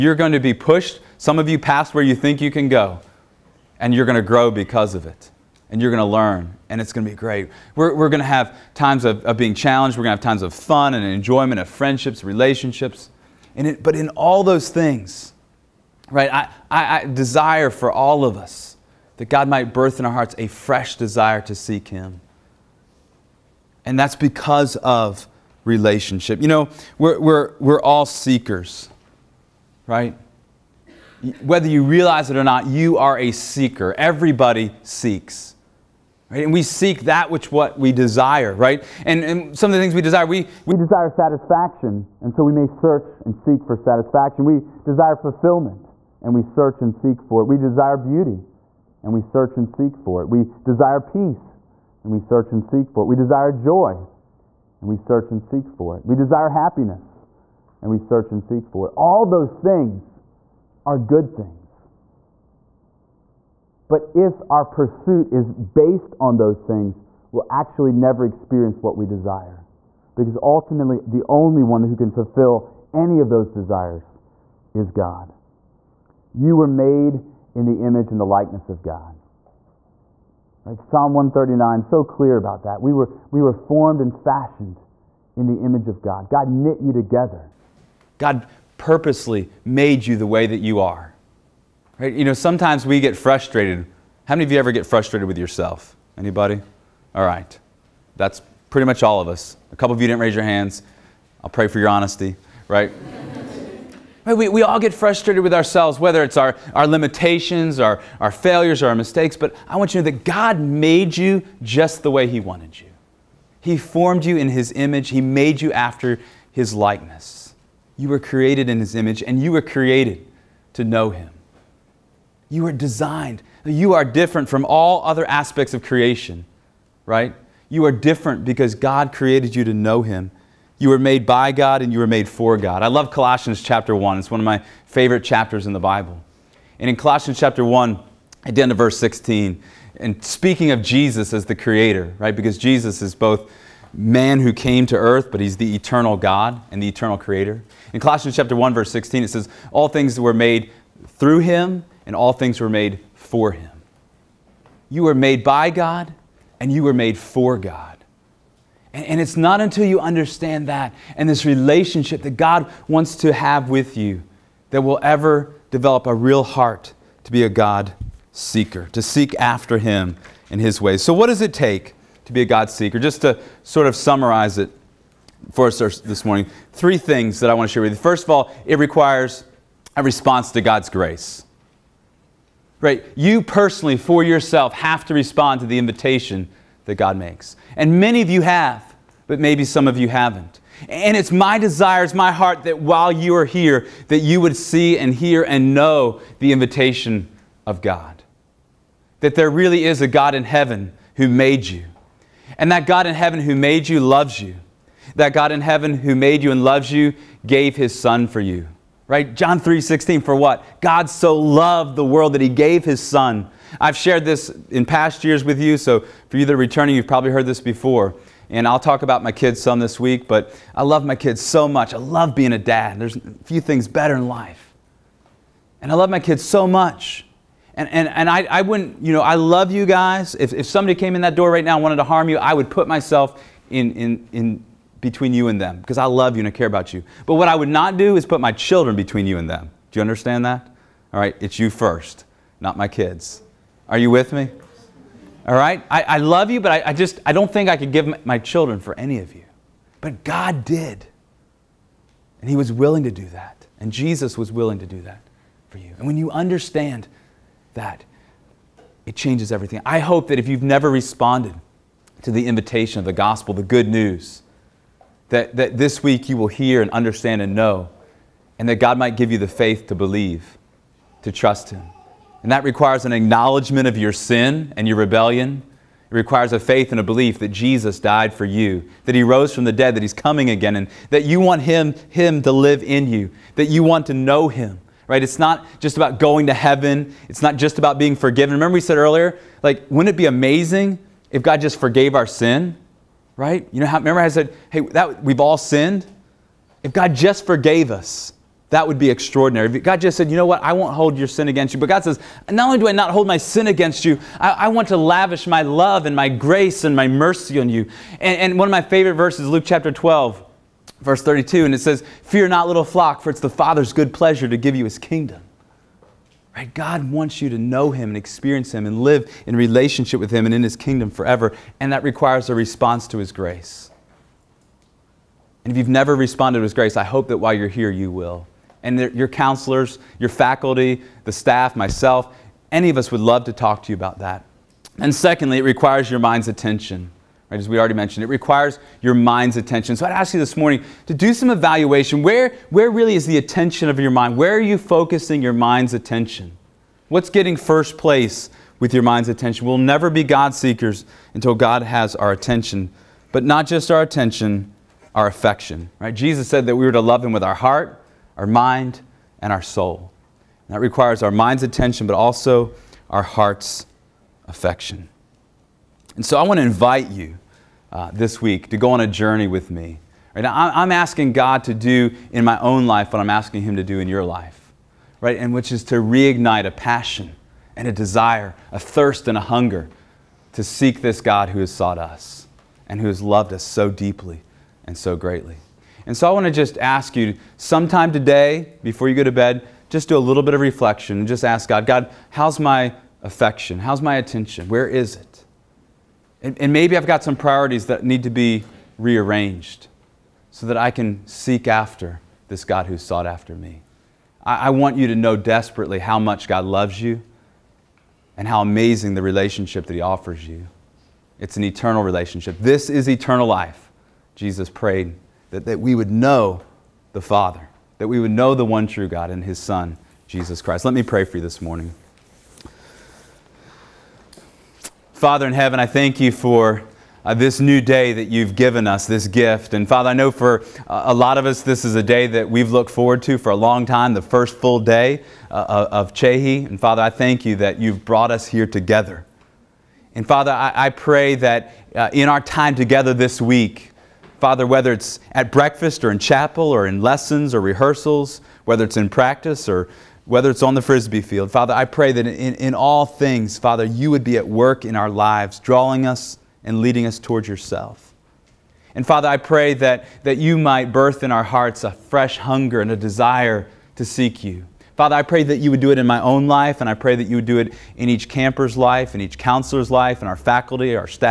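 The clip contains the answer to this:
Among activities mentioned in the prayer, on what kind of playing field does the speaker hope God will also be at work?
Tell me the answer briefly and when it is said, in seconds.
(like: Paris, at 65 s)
frisbee field, at 450 s.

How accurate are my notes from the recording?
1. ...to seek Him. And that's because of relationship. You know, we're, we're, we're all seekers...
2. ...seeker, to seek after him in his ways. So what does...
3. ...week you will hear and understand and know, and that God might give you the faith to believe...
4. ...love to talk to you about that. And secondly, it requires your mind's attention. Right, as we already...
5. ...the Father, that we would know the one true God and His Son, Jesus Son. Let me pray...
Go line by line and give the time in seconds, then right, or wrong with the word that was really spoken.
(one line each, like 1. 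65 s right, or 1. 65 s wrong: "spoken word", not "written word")
1. 21 s right
2. 168 s right
3. 266 s right
4. 333 s right
5. 417 s wrong: "Christ", not "Son".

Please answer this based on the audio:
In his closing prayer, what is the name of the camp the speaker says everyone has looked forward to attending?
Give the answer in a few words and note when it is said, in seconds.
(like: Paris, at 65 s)
Csehy, at 436 s.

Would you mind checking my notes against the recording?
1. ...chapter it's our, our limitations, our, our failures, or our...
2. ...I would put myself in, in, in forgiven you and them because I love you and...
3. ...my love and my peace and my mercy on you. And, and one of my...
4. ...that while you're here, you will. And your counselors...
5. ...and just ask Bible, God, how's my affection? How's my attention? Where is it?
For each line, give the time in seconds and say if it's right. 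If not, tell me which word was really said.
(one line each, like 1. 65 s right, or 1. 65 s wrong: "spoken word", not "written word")
1. 105 s wrong: "whether", not "chapter"
2. 232 s wrong: "between", not "forgiven"
3. 305 s wrong: "grace", not "peace"
4. 327 s right
5. 391 s wrong: "God", not "Bible".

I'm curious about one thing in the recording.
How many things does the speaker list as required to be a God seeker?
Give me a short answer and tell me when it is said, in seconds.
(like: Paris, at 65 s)
3, at 176 s.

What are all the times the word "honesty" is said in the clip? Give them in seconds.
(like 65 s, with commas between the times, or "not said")
101 s.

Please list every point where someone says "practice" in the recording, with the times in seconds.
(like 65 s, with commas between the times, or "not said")
449 s.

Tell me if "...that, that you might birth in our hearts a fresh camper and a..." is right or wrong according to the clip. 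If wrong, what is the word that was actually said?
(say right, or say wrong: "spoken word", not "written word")
wrong: "hunger", not "camper".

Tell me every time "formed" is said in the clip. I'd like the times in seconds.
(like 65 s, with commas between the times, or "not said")
83 s, 113 s.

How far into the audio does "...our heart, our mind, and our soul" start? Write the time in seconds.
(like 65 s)
357 s.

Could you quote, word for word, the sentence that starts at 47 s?
We desire beauty, and we search and seek for it.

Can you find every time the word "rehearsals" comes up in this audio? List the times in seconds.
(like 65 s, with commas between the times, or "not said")
447 s.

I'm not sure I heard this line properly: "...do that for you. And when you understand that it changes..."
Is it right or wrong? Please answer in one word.
right.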